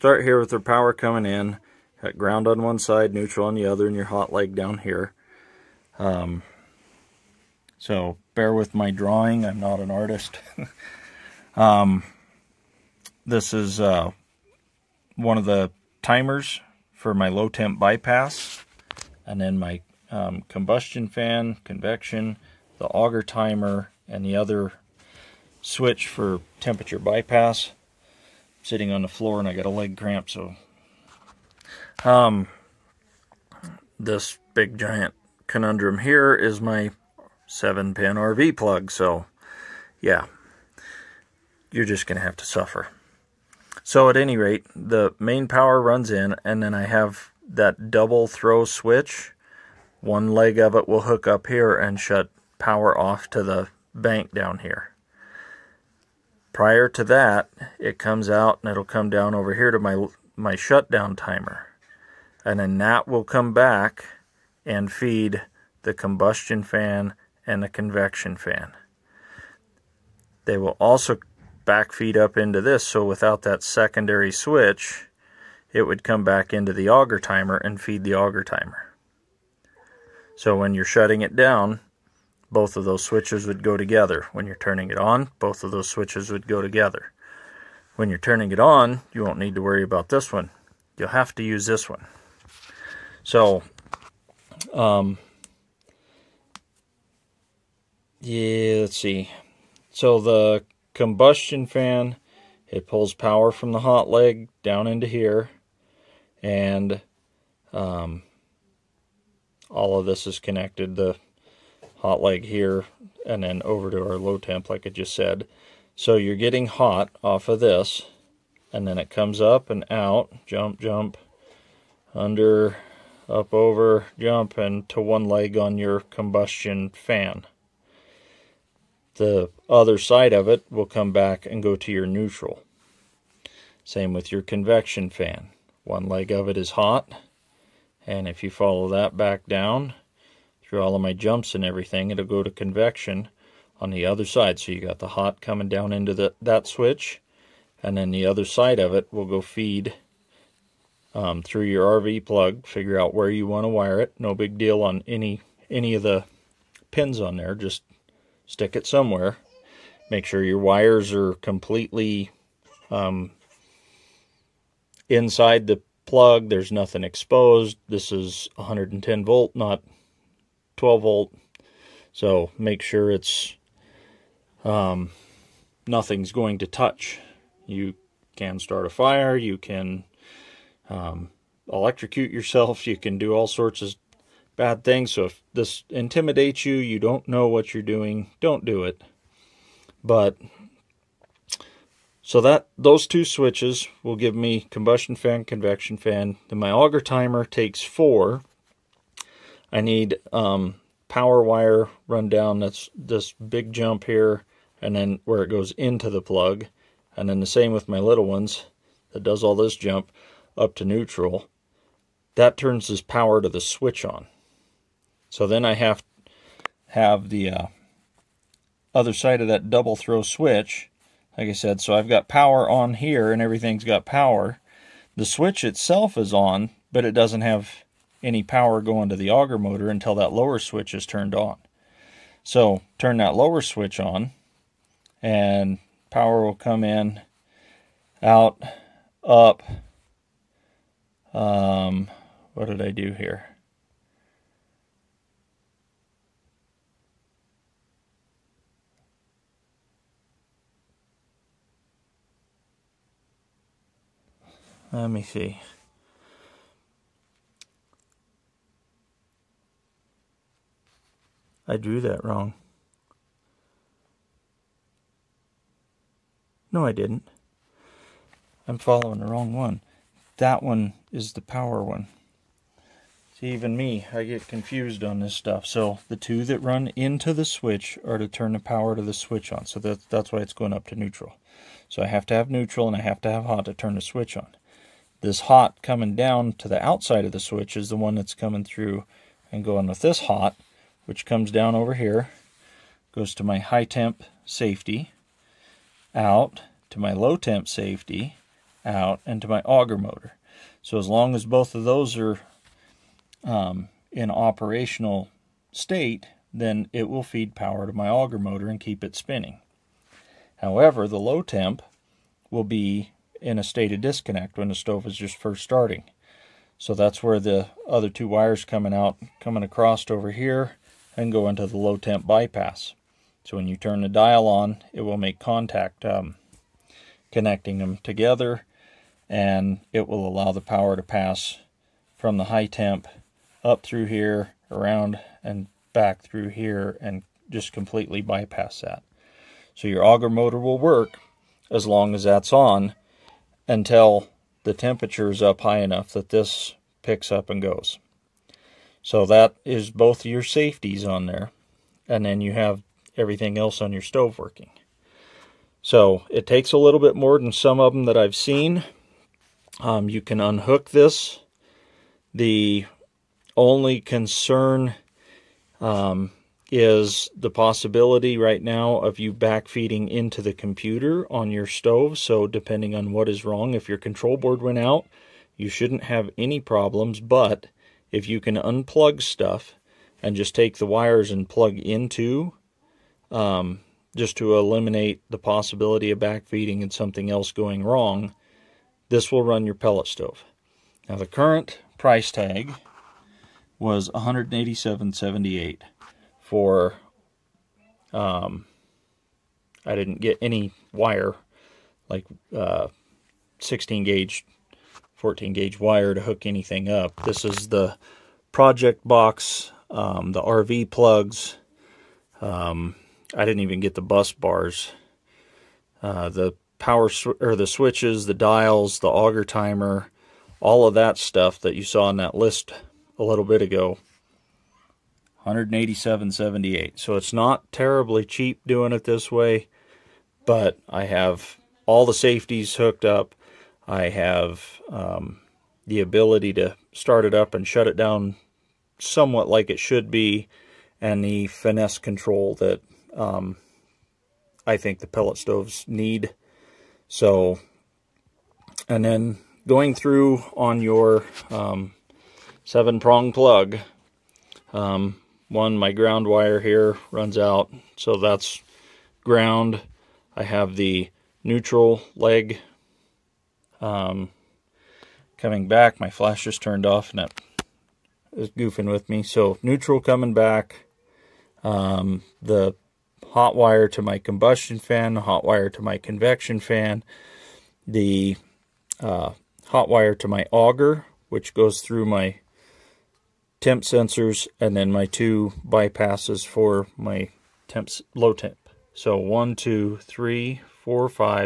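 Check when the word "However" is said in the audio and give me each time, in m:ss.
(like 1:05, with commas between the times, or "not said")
5:10.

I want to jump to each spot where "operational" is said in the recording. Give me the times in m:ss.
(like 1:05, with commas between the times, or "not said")
5:04.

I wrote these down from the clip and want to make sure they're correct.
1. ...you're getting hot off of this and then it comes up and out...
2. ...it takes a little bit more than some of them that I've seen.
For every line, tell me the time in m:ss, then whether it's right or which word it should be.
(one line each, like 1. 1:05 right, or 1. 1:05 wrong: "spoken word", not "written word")
1. 1:56 right
2. 5:56 right.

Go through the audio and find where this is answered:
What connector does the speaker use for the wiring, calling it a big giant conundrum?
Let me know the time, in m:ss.
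0:37.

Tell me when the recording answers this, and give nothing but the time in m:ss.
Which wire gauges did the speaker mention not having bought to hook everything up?
6:43.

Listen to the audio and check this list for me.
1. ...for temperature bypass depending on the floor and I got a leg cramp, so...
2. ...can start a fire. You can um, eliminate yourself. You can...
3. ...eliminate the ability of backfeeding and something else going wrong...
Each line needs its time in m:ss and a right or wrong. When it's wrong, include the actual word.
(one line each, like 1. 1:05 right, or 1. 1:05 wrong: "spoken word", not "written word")
1. 0:26 wrong: "sitting", not "depending"
2. 2:58 wrong: "electrocute", not "eliminate"
3. 6:24 wrong: "possibility", not "ability".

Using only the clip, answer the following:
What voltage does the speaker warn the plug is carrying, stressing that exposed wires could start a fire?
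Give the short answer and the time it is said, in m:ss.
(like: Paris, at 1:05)
110 volt, at 2:48.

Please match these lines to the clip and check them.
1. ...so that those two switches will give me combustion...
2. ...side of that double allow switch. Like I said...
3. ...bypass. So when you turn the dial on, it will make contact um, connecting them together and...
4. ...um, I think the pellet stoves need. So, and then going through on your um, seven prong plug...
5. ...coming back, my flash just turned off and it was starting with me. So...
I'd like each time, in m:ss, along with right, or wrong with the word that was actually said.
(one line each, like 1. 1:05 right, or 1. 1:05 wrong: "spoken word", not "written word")
1. 3:12 right
2. 3:39 wrong: "throw", not "allow"
3. 5:22 right
4. 7:23 right
5. 7:45 wrong: "goofing", not "starting".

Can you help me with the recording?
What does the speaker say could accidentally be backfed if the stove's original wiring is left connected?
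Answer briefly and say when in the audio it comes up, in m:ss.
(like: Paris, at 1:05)
the computer, at 6:10.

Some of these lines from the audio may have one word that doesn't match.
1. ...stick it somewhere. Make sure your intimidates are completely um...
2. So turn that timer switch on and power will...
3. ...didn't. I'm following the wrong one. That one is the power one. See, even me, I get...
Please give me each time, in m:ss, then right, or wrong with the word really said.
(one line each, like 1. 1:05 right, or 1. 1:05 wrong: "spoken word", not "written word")
1. 2:38 wrong: "wires", not "intimidates"
2. 3:52 wrong: "lower", not "timer"
3. 4:26 right.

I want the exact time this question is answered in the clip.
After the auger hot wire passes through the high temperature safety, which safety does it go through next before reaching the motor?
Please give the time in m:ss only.
4:57.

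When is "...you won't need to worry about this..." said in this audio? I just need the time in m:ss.
1:29.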